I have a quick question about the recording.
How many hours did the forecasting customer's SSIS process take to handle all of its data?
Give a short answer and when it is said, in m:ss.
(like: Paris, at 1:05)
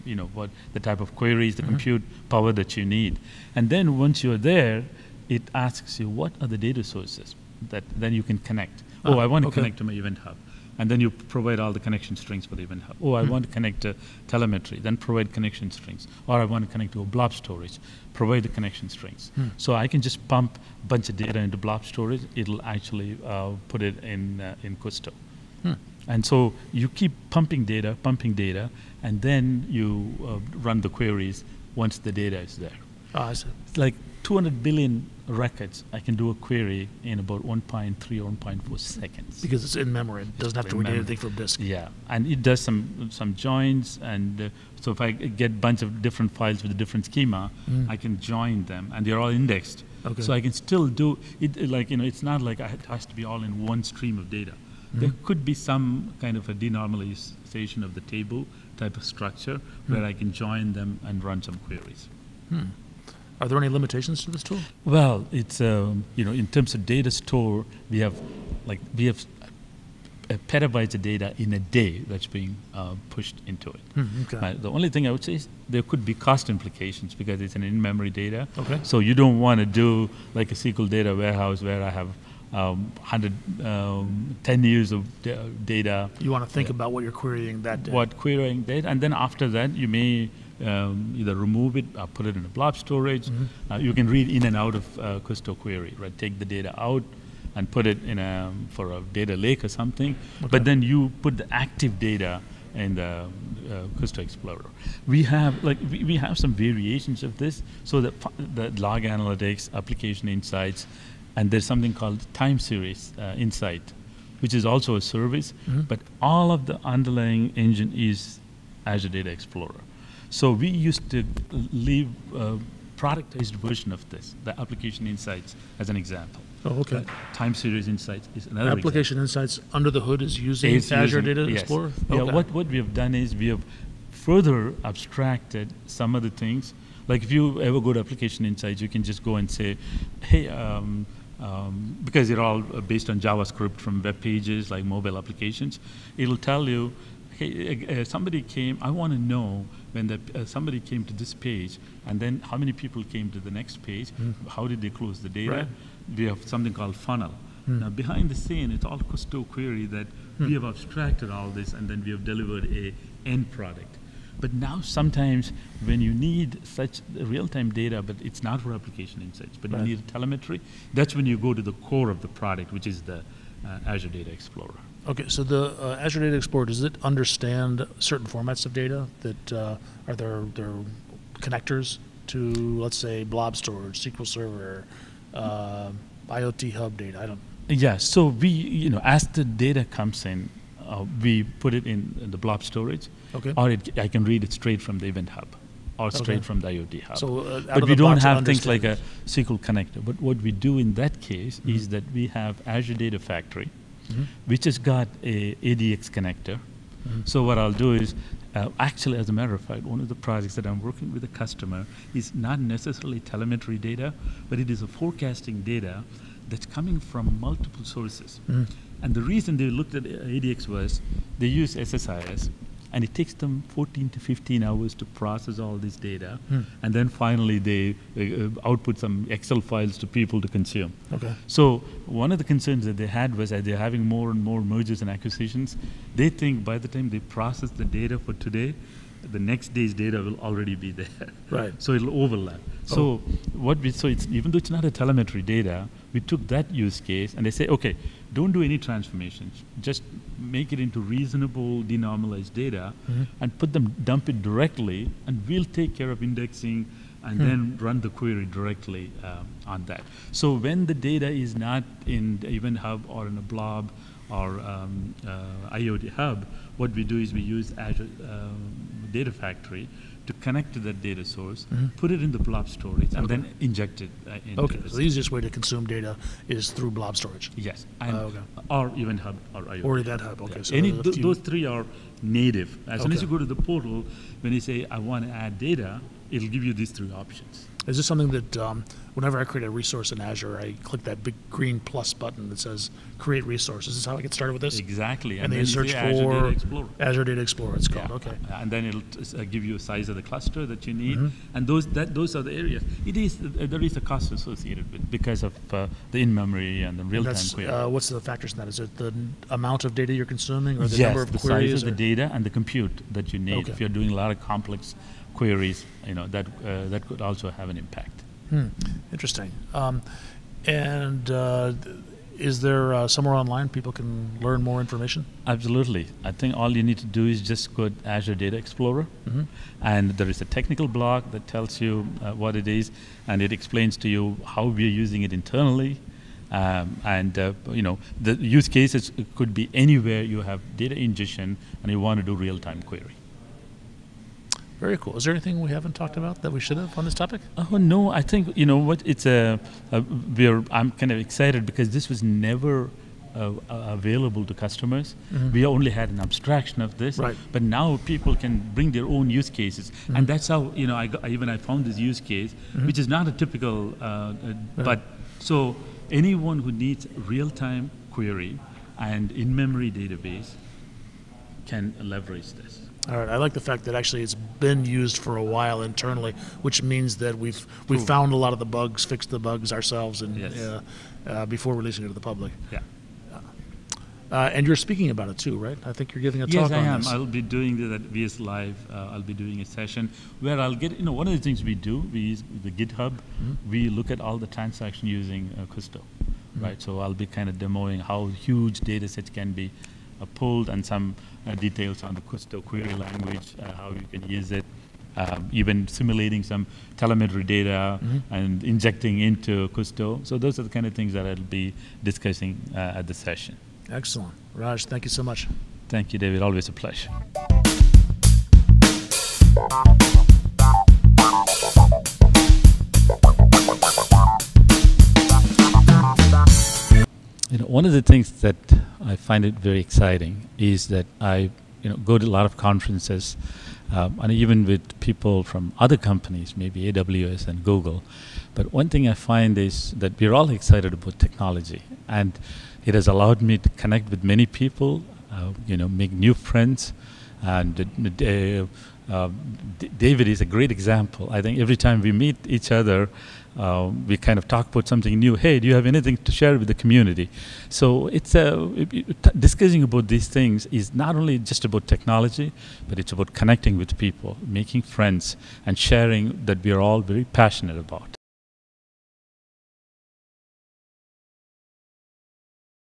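14 to 15 hours, at 3:43.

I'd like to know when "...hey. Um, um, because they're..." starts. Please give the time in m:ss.
2:20.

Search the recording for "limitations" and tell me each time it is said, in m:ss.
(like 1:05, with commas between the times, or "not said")
1:03.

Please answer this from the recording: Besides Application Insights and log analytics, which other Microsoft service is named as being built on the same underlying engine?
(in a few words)
Time Series Insights.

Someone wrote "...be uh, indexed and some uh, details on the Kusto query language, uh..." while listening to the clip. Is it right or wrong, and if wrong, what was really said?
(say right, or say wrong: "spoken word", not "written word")
wrong: "pulled", not "indexed".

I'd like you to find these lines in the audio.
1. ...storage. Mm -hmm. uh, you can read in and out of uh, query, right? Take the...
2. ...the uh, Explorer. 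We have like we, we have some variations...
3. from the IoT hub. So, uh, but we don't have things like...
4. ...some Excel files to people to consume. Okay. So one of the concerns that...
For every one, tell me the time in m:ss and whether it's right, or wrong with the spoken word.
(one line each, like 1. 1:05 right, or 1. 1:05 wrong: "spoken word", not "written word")
1. 1:32 right
2. 1:42 right
3. 3:16 right
4. 3:48 right.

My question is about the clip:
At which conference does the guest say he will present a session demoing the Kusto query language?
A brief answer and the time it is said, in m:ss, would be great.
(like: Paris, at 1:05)
VS Live, at 6:28.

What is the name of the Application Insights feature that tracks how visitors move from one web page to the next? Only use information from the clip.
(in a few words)
Funnel.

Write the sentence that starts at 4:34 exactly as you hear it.
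Uh, okay, so the easiest way to consume data is through blob storage.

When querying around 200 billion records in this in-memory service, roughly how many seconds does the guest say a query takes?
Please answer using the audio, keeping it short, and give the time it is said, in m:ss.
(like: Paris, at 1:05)
1.3 or 1.4 seconds, at 0:37.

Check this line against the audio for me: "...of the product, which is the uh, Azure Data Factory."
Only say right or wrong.
wrong.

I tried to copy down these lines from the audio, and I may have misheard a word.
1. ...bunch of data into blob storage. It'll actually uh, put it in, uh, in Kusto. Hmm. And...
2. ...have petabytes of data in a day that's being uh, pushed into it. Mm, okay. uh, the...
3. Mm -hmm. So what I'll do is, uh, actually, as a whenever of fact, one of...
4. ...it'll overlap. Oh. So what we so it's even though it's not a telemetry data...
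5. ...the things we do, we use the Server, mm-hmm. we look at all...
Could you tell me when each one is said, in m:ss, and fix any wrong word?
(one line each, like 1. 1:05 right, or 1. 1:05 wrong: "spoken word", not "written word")
1. 0:20 right
2. 1:09 right
3. 3:26 wrong: "matter", not "whenever"
4. 4:01 right
5. 6:31 wrong: "GitHub", not "Server".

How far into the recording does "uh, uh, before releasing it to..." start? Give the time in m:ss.
6:20.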